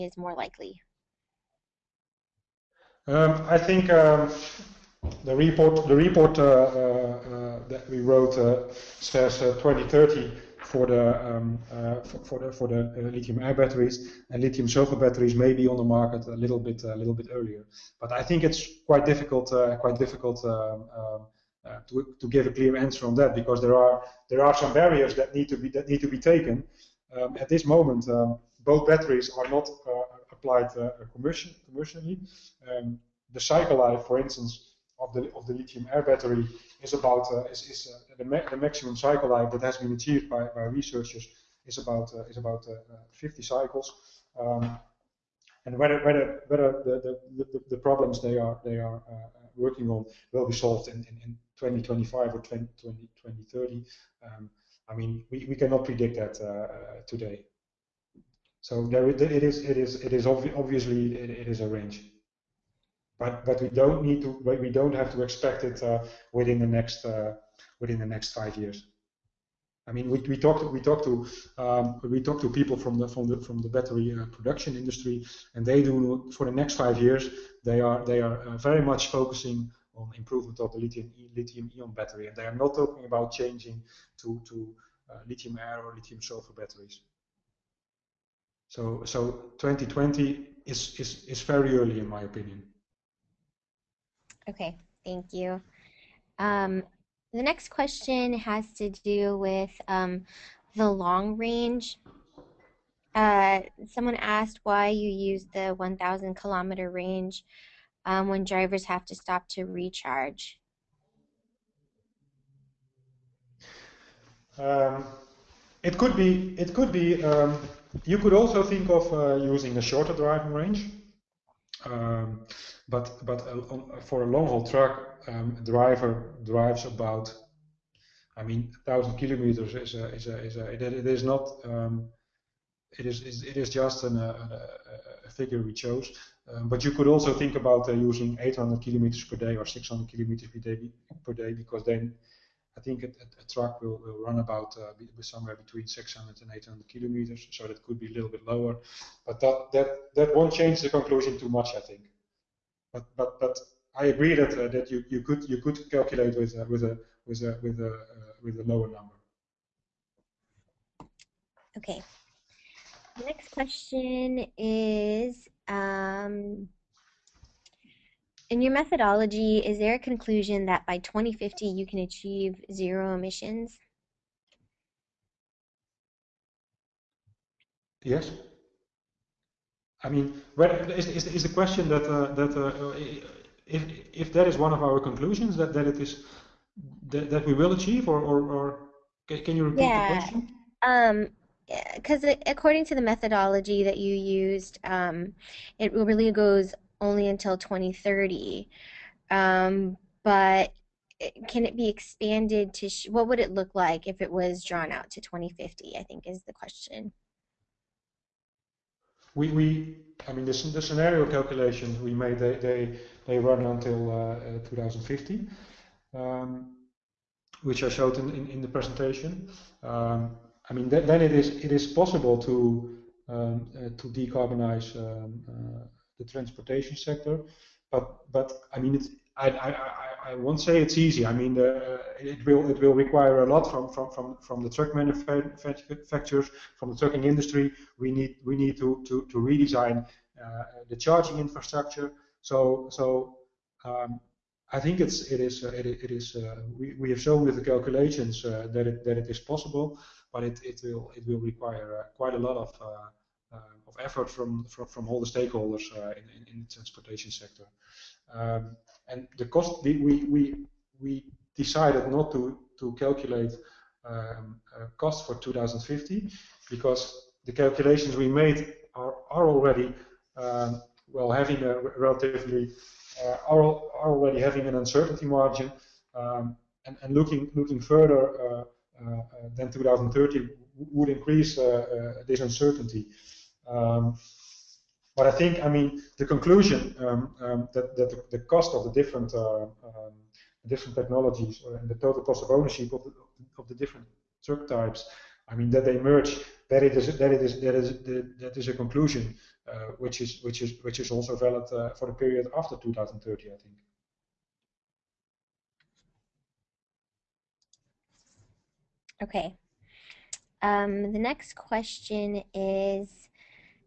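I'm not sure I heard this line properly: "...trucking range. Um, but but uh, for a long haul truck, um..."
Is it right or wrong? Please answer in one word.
wrong.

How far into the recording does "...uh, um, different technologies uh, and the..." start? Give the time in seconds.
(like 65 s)
289 s.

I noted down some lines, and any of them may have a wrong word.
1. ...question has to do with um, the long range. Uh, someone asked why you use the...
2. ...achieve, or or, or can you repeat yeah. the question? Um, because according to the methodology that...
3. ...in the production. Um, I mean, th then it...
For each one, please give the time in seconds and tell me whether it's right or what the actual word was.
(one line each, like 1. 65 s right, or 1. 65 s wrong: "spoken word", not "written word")
1. 97 s right
2. 187 s right
3. 218 s wrong: "presentation", not "production".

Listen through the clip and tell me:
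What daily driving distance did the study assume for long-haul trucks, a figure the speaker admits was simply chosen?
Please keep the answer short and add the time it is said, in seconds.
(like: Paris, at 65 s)
1,000 kilometers, at 128 s.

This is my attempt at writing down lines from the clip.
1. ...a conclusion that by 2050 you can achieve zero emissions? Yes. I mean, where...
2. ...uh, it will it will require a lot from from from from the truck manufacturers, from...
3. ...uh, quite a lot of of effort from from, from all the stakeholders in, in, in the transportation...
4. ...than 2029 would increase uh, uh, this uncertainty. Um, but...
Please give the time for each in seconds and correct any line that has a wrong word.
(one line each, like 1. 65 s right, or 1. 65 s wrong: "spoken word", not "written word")
1. 169 s right
2. 231 s right
3. 251 s right
4. 279 s wrong: "2030", not "2029".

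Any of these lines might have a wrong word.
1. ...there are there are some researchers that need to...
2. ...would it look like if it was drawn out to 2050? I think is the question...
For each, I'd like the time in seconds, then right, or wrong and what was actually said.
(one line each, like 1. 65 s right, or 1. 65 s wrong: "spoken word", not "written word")
1. 23 s wrong: "barriers", not "researchers"
2. 203 s right.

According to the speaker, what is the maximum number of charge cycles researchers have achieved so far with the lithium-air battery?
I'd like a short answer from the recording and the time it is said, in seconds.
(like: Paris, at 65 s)
50 cycles, at 43 s.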